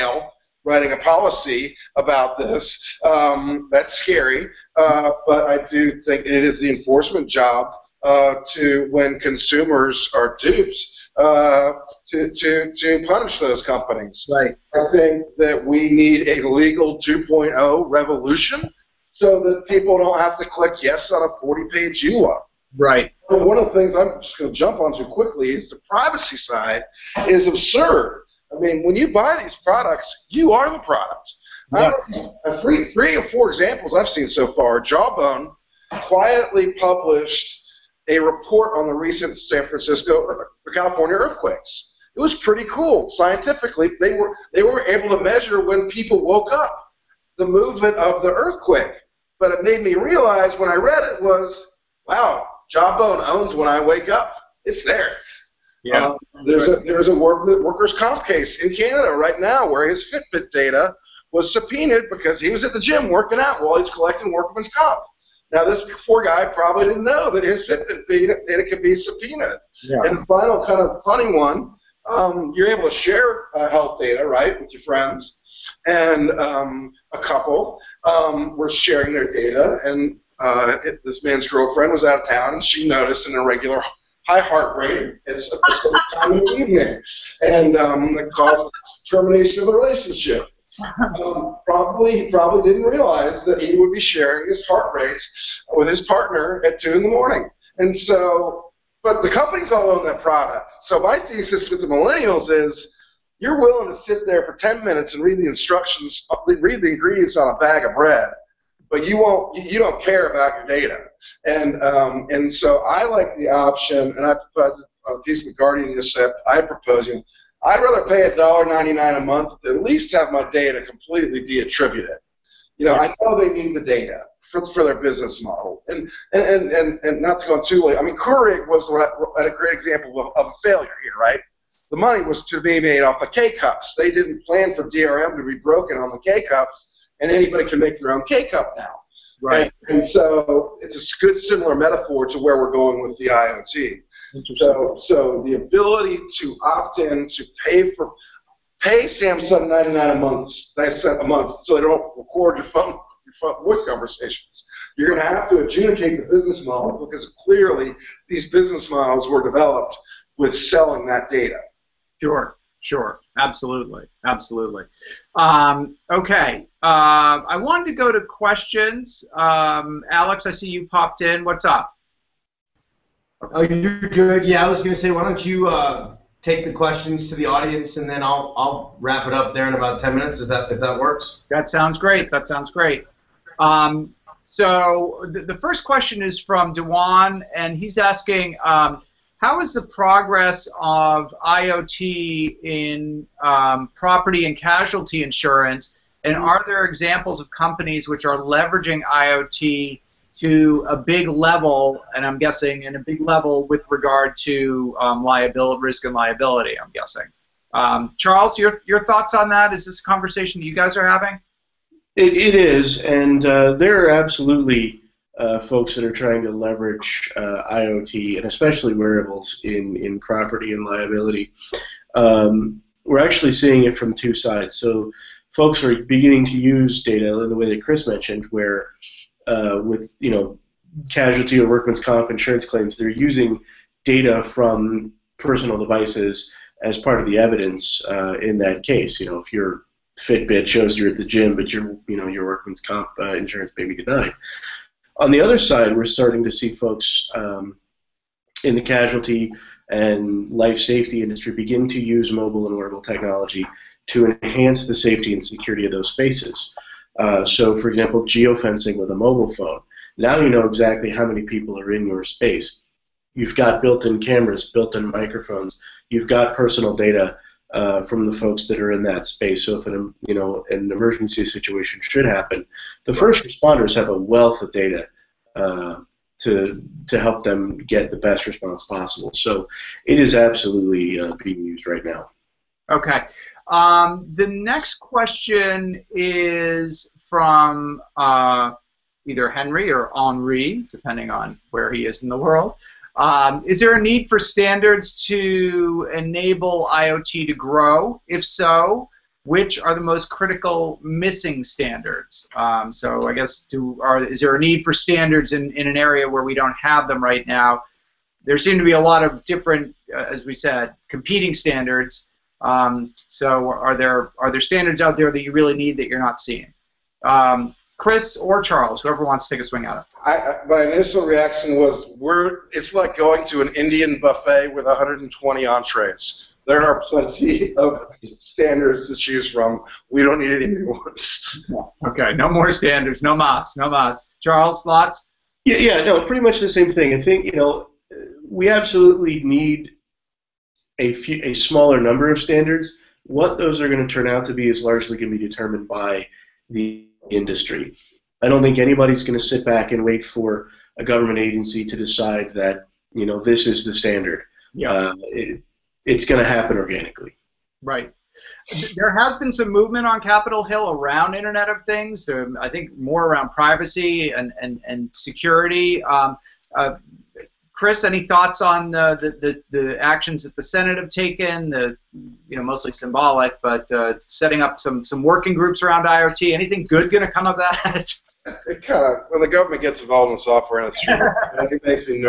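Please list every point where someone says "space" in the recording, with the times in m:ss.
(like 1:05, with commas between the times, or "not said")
4:16, 4:22, 4:29.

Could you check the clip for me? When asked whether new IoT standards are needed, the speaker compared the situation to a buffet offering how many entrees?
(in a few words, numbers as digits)
120.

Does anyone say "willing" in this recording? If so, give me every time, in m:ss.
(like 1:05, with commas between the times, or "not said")
1:43.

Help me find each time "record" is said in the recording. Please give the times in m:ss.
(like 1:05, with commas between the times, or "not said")
2:32.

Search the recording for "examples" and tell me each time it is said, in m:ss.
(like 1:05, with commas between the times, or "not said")
0:33, 2:09, 3:16, 4:17.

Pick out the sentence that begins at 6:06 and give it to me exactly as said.
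Um, uh, Chris, any thoughts on the, the, the, the, actions that the Senate have taken?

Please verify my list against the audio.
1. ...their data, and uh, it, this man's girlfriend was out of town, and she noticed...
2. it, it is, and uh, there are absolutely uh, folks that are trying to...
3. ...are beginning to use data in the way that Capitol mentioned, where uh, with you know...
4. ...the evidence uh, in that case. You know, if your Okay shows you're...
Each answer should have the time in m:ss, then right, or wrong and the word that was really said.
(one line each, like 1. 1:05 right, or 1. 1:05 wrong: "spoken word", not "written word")
1. 1:19 right
2. 3:32 right
3. 3:45 wrong: "Chris", not "Capitol"
4. 3:57 wrong: "Fitbit", not "Okay".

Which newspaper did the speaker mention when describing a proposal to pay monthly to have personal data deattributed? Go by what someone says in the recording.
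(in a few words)
the Guardian.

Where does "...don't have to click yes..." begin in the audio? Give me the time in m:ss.
0:19.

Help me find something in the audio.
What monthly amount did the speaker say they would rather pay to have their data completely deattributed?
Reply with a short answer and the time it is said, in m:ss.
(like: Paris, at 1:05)
$1.99, at 1:58.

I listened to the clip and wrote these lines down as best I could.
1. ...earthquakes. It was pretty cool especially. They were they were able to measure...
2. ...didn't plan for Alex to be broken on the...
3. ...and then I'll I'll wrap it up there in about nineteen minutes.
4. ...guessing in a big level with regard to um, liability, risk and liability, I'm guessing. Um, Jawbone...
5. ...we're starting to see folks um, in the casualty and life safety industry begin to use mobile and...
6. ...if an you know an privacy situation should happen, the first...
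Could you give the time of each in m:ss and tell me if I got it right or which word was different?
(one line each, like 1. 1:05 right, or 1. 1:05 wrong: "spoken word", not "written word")
1. 0:41 wrong: "scientifically", not "especially"
2. 2:14 wrong: "DRM", not "Alex"
3. 2:57 wrong: "ten", not "nineteen"
4. 3:22 wrong: "Charles", not "Jawbone"
5. 4:05 right
6. 4:29 wrong: "emergency", not "privacy".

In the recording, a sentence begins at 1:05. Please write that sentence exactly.
Now, this poor guy probably didn't know that his Fitbit data could be subpoenaed.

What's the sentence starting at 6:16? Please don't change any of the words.
Anything good going to come of that?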